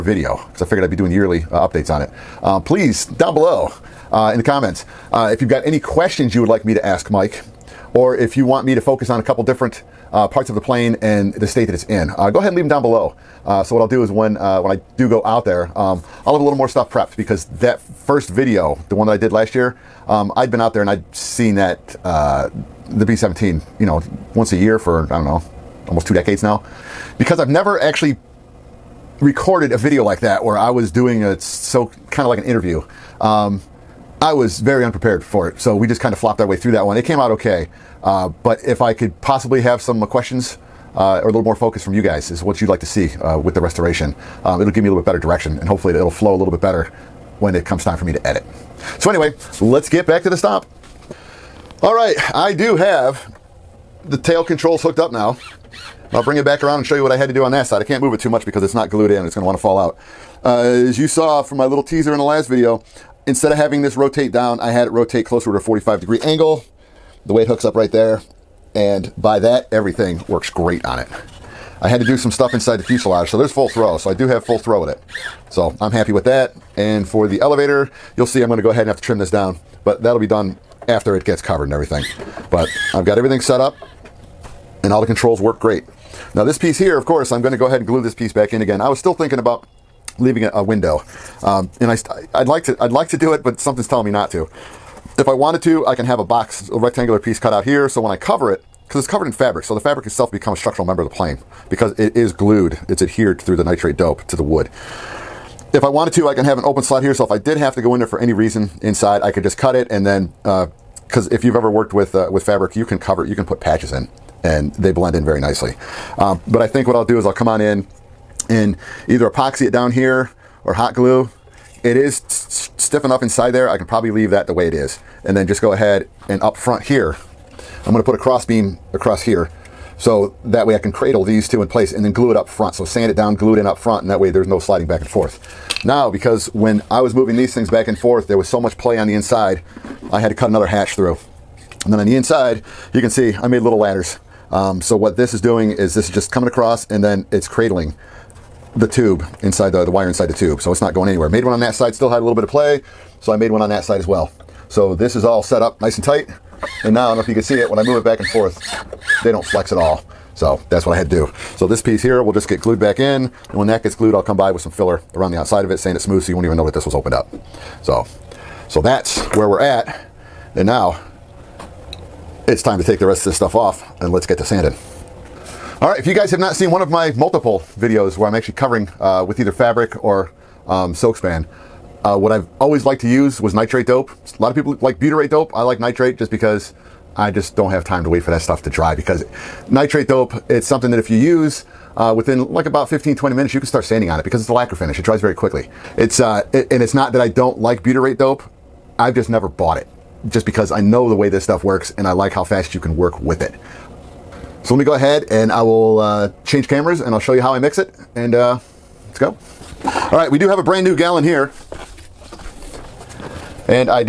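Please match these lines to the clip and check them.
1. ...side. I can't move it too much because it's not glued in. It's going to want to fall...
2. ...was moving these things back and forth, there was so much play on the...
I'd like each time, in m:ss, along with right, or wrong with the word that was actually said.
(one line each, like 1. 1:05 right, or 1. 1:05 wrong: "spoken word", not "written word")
1. 0:57 right
2. 2:17 right.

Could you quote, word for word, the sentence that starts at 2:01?
It is stiff enough inside there.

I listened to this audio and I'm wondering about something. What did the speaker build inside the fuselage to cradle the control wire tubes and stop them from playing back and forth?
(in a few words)
Little ladders.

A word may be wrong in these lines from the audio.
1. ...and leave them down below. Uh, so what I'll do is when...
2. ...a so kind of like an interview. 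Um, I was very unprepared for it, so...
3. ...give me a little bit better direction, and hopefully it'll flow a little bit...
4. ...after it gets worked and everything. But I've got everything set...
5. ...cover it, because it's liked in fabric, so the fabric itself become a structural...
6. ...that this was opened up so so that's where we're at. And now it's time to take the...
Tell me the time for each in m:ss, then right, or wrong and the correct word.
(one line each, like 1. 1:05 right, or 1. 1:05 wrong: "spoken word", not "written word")
1. 0:12 right
2. 0:31 right
3. 0:44 right
4. 1:20 wrong: "covered", not "worked"
5. 1:38 wrong: "covered", not "liked"
6. 2:46 right.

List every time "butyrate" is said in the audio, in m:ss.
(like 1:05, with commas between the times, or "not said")
3:04, 3:17.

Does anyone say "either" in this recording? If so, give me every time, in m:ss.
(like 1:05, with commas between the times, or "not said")
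1:59, 2:59.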